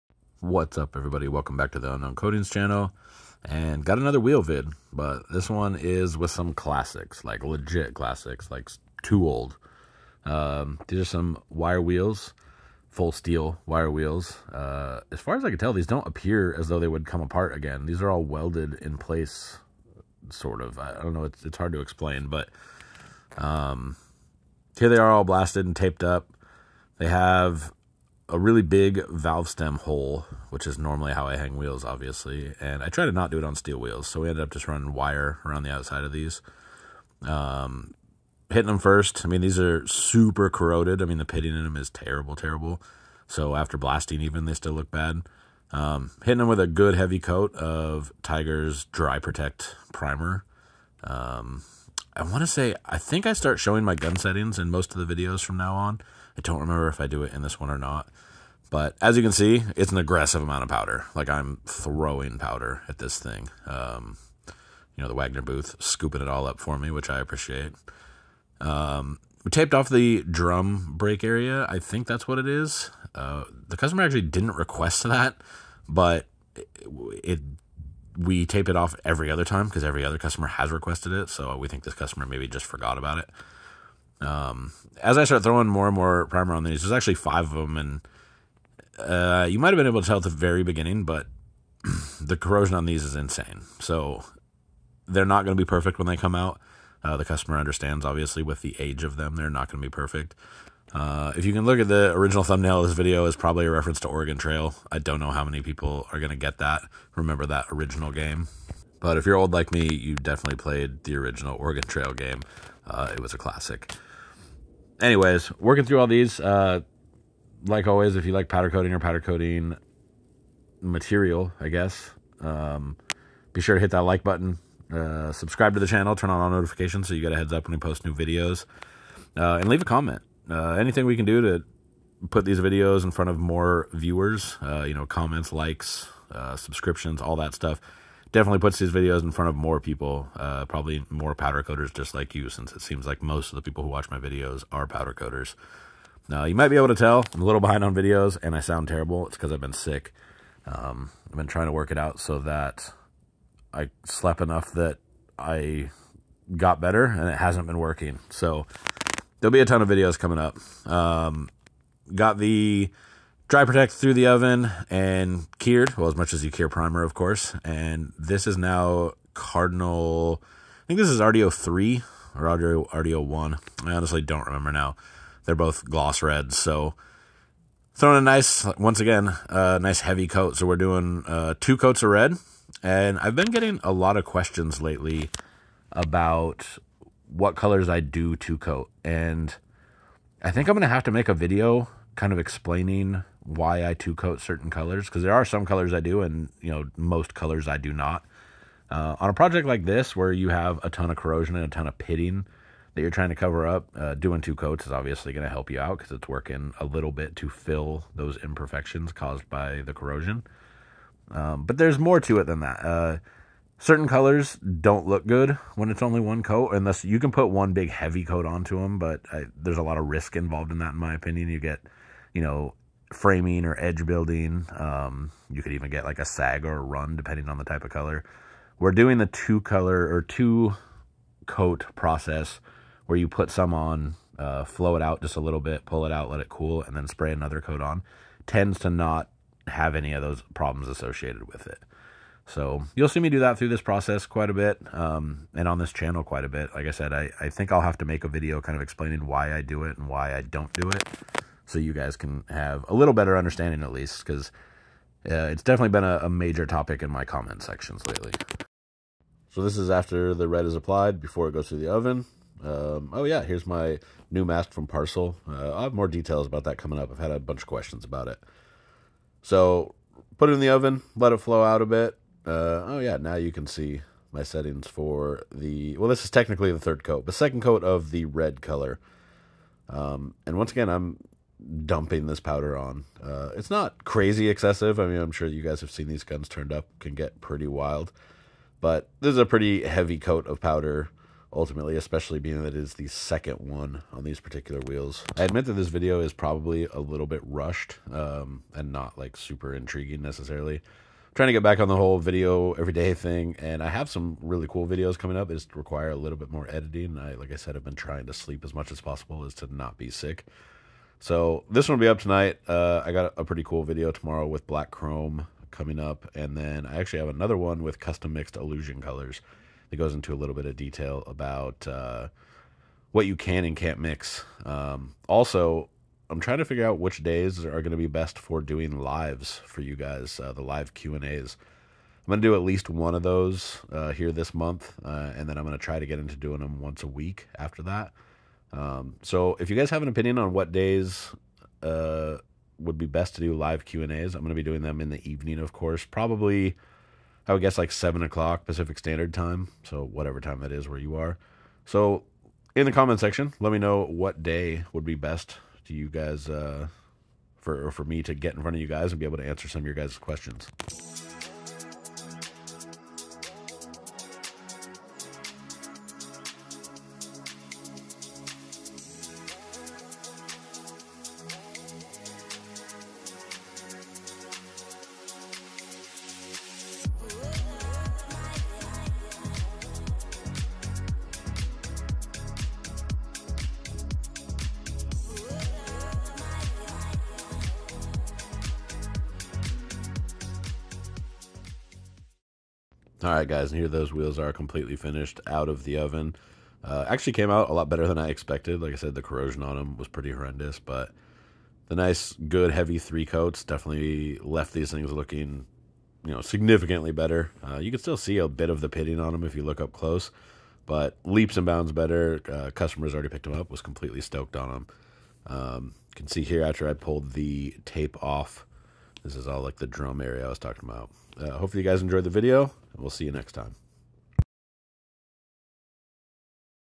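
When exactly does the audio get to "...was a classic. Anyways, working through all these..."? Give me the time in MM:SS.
01:53.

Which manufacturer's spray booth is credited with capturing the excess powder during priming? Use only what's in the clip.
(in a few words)
Wagner.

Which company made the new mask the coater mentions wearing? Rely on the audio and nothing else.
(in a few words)
Parcil.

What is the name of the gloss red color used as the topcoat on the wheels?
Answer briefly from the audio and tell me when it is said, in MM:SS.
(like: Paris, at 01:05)
Cardinal, at 02:49.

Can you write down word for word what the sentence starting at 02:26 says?
Now, you might be able to tell I'm a little behind on videos and I sound terrible.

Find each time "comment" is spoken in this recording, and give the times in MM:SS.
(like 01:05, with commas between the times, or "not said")
02:09, 02:15, 04:17, 05:52.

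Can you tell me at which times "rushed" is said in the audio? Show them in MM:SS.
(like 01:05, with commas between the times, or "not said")
04:57.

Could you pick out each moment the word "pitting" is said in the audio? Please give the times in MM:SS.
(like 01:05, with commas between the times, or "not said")
00:41, 03:21, 06:48.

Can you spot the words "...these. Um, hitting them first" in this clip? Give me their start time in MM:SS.
00:36.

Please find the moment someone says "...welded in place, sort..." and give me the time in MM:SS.
00:18.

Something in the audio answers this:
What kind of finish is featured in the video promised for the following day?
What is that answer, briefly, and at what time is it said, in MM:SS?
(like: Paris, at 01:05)
Black Chrome, at 05:14.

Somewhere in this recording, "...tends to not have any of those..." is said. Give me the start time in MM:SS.
03:58.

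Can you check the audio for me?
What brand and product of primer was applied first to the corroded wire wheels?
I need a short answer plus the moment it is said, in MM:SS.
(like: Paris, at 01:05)
Tiger Dry Protect, at 00:48.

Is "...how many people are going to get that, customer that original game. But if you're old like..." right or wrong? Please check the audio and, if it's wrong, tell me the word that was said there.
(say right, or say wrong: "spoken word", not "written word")
wrong: "remember", not "customer".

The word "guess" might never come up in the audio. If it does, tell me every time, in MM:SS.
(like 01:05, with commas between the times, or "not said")
02:01, 05:47.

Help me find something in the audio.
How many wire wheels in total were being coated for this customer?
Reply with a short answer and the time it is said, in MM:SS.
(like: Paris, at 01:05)
5, at 01:27.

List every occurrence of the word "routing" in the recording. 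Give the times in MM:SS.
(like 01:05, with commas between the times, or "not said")
not said.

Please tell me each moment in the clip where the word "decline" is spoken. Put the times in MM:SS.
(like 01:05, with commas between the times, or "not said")
not said.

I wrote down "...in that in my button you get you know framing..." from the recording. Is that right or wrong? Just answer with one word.
wrong.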